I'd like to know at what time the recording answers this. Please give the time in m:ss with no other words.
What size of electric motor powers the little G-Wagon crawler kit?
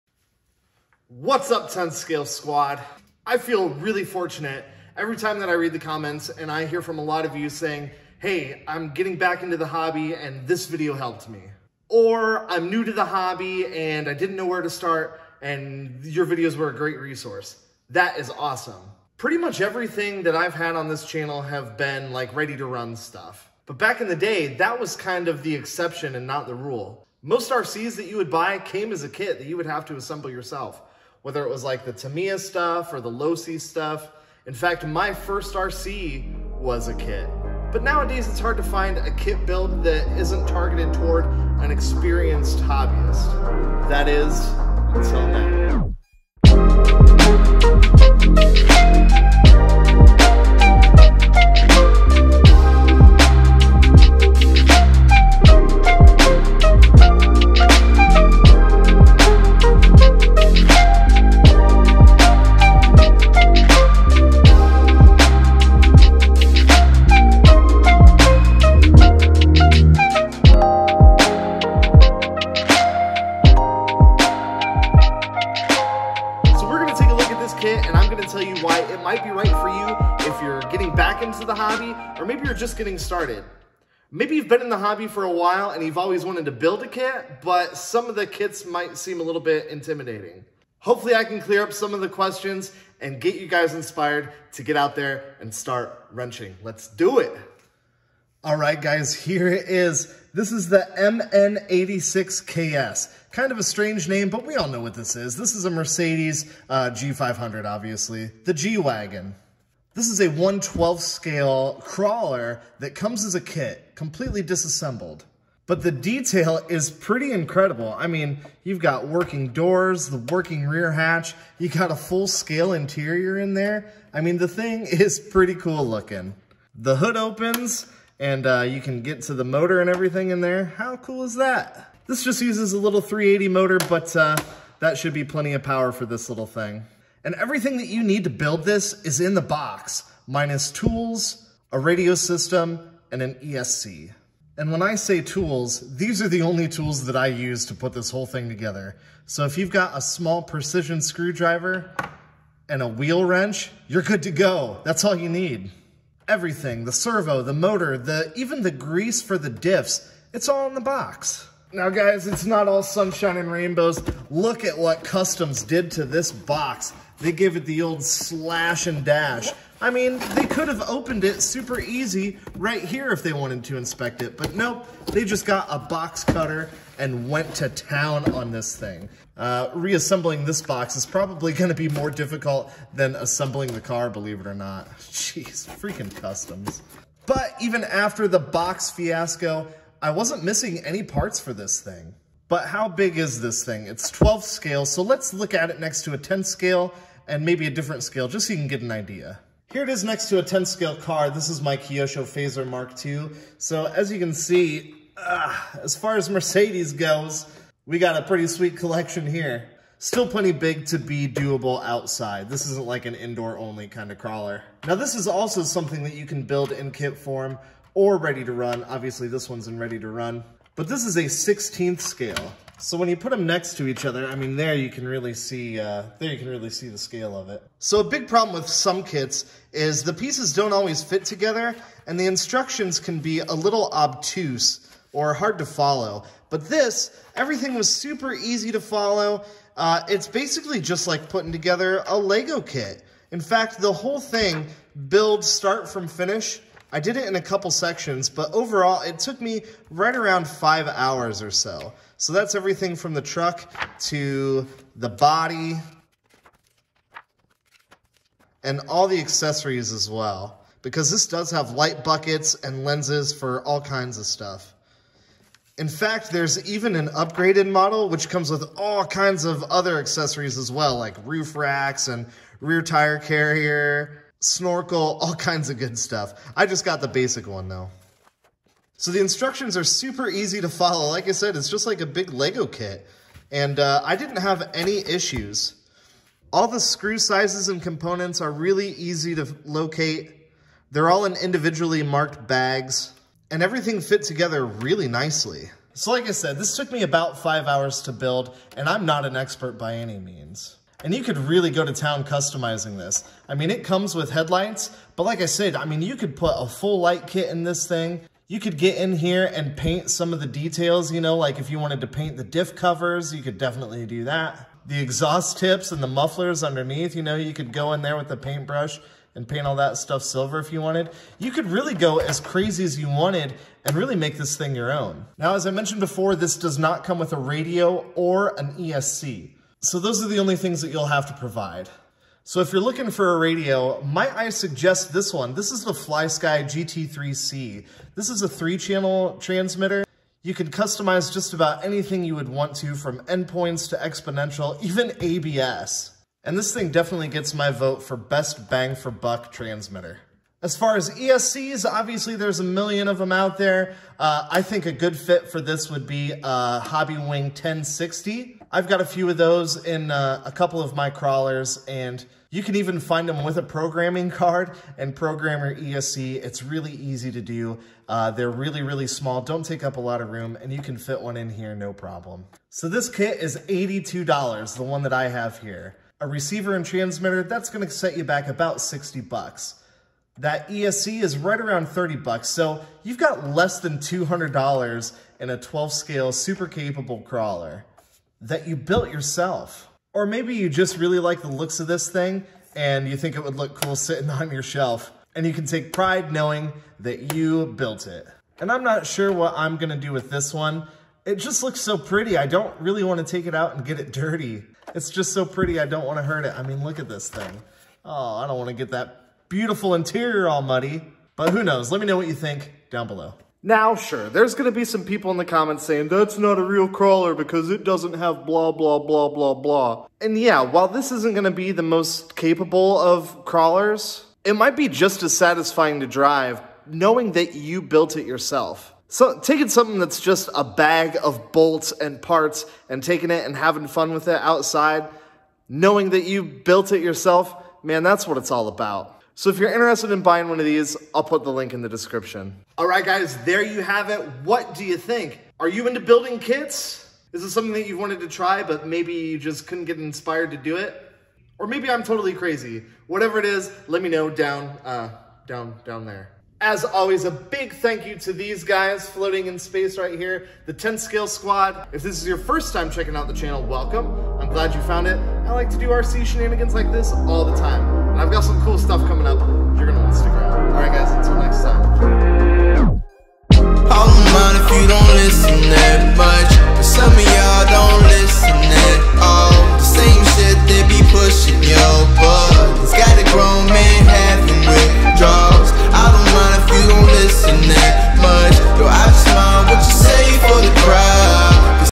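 2:13.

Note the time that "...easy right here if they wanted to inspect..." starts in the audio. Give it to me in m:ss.
2:51.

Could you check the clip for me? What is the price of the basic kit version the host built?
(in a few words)
$82.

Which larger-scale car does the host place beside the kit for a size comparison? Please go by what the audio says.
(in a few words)
Kyosho Fazer Mark II.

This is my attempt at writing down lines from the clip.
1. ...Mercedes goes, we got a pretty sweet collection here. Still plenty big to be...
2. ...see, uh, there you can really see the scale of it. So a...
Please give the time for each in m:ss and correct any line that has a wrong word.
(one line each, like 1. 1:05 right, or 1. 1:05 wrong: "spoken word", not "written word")
1. 3:26 right
2. 3:45 right.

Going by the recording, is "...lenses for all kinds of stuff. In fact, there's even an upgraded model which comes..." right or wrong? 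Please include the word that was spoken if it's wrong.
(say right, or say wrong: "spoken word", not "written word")
right.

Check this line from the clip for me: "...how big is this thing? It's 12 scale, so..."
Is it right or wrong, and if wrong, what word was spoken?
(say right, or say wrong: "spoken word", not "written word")
right.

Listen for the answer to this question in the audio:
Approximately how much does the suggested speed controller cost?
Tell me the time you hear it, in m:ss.
6:21.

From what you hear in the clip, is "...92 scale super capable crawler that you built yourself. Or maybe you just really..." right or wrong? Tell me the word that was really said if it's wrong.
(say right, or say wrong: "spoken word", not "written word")
wrong: "12", not "92".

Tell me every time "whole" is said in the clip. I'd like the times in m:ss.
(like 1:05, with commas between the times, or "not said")
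2:28, 4:03.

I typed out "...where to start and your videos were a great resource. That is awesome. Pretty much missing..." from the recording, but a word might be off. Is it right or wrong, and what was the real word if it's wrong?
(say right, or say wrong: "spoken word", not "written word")
wrong: "everything", not "missing".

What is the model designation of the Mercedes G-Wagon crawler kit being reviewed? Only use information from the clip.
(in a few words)
MN86KS.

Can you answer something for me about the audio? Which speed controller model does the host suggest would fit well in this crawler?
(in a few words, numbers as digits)
Hobbywing 1060.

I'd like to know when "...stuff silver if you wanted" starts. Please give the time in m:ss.
5:19.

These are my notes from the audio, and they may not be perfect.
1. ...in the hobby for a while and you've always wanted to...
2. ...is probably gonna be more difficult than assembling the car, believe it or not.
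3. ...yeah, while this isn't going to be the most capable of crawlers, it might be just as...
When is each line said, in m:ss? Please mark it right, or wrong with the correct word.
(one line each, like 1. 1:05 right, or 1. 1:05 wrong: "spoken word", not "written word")
1. 1:24 right
2. 3:00 right
3. 7:00 right.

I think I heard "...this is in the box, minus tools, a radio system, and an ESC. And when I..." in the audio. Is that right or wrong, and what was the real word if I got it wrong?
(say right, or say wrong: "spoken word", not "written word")
right.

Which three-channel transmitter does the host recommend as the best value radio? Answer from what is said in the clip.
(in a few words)
FlySky GT3C.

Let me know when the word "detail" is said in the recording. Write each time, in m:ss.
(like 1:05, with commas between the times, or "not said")
1:55, 5:10.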